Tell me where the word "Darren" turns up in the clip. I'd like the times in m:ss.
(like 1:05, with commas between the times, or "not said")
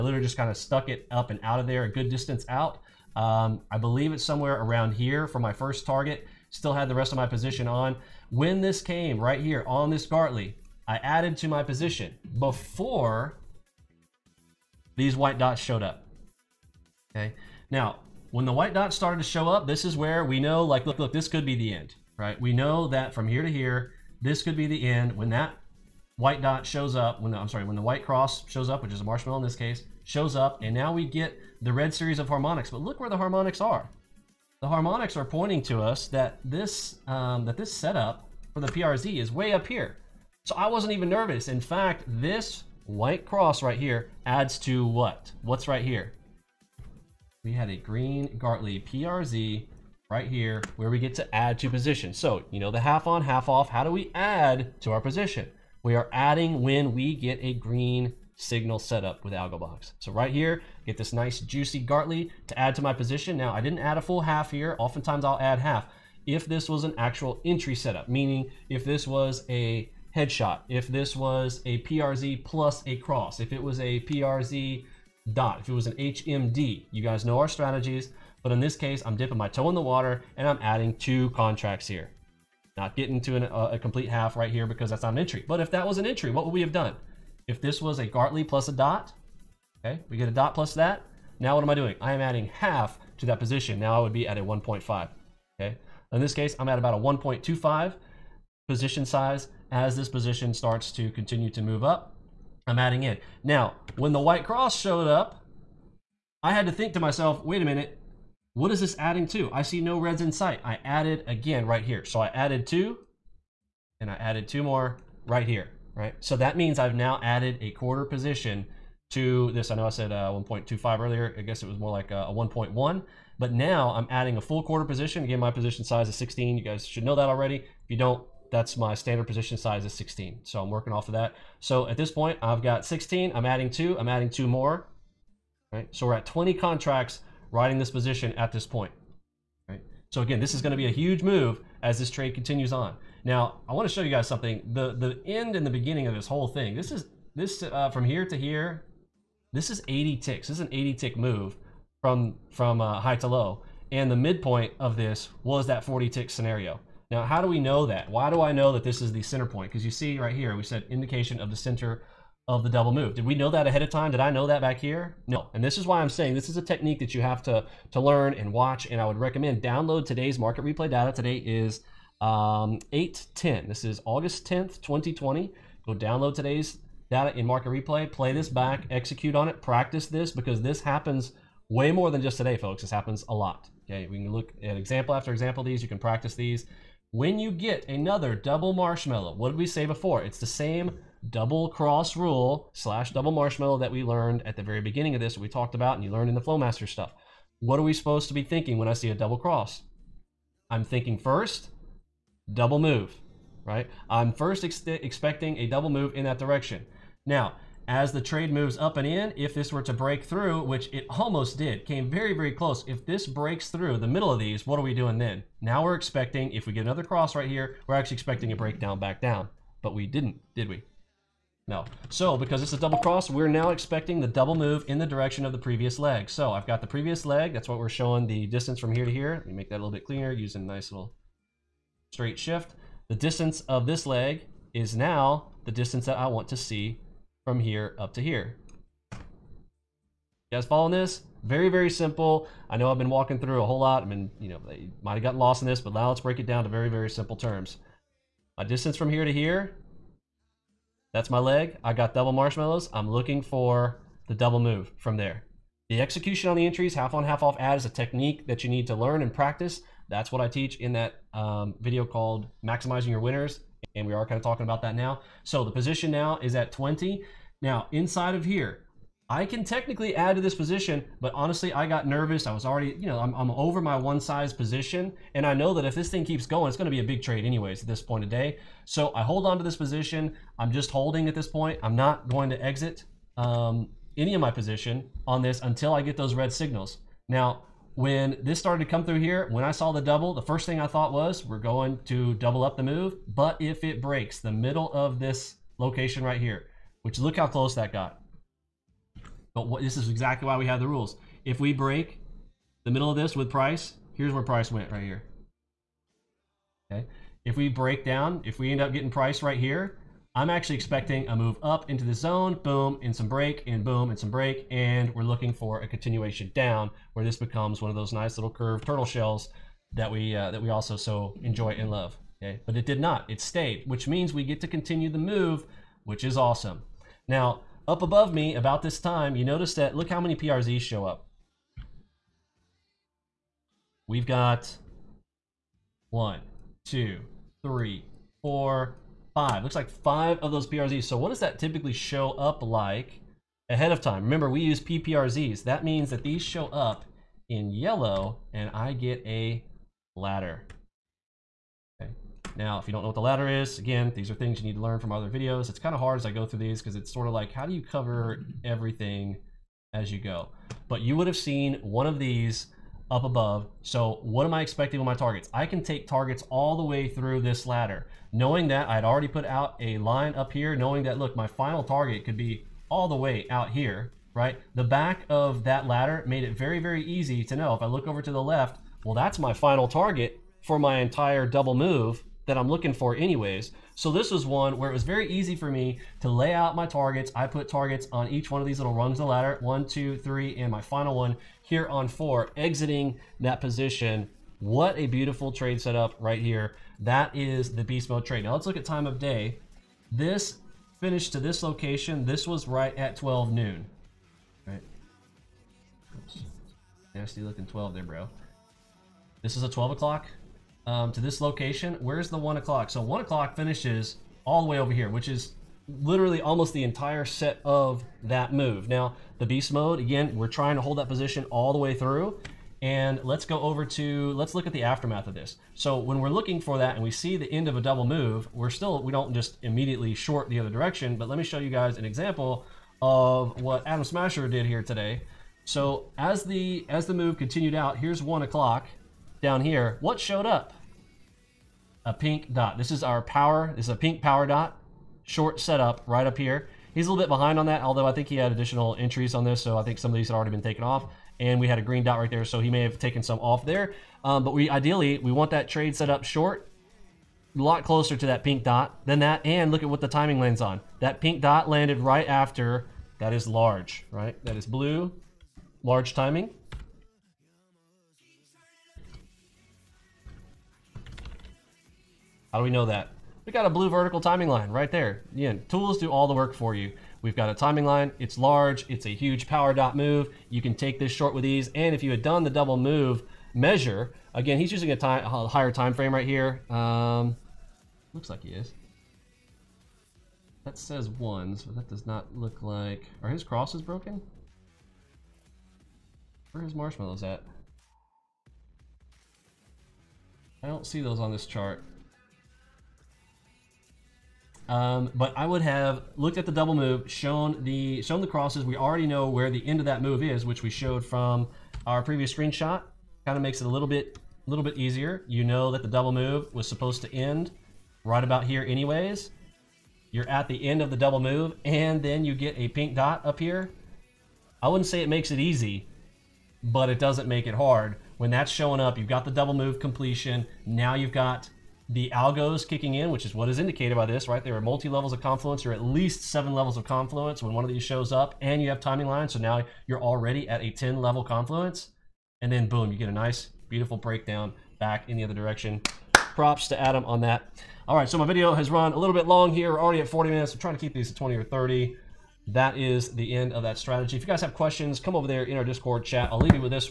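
not said.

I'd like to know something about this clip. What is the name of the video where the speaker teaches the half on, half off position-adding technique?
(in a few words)
Maximizing Your Winners.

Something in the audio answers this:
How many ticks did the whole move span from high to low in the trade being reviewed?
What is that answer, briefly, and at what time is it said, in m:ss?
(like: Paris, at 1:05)
80, at 2:29.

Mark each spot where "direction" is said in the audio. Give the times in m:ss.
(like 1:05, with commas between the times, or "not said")
3:26, 3:45, 7:10, 9:05.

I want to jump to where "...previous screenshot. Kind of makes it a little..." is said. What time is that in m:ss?
8:32.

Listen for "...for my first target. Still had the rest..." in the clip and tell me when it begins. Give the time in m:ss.
0:05.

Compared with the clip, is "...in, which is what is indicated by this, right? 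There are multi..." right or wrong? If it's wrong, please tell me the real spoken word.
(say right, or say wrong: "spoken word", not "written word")
right.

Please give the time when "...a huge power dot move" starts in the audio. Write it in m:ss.
7:59.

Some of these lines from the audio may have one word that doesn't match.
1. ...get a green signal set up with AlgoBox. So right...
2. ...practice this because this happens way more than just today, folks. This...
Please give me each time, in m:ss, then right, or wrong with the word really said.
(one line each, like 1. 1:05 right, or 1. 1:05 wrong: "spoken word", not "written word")
1. 0:57 right
2. 2:59 right.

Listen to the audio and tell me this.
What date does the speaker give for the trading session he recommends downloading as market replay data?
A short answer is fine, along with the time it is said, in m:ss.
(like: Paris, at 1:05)
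August 10th, 2020, at 2:54.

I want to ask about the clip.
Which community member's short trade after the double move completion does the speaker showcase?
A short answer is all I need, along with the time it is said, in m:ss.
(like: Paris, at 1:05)
Adam Smasher, at 7:13.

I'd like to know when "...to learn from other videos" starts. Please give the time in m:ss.
5:54.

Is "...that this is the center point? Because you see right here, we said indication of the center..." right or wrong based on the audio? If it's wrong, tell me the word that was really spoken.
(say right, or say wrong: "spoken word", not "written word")
right.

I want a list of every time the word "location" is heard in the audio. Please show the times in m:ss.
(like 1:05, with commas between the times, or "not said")
4:55, 6:41, 6:51.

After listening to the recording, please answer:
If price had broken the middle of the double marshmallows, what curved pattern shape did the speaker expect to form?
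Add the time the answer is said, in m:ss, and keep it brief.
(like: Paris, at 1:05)
turtle shells, at 5:18.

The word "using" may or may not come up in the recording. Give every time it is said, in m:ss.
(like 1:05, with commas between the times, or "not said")
3:50, 8:04.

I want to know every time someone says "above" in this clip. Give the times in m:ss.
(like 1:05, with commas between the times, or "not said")
5:28, 6:03.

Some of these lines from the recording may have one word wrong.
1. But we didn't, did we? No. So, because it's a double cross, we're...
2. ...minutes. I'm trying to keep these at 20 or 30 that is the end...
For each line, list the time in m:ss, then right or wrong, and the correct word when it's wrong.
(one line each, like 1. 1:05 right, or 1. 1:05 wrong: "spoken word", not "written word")
1. 3:39 right
2. 9:10 right.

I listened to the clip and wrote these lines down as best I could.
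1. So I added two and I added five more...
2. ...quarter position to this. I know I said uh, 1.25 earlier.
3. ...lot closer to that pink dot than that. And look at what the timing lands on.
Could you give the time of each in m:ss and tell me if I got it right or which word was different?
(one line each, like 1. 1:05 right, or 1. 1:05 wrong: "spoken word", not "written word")
1. 1:52 wrong: "two", not "five"
2. 1:57 right
3. 7:37 right.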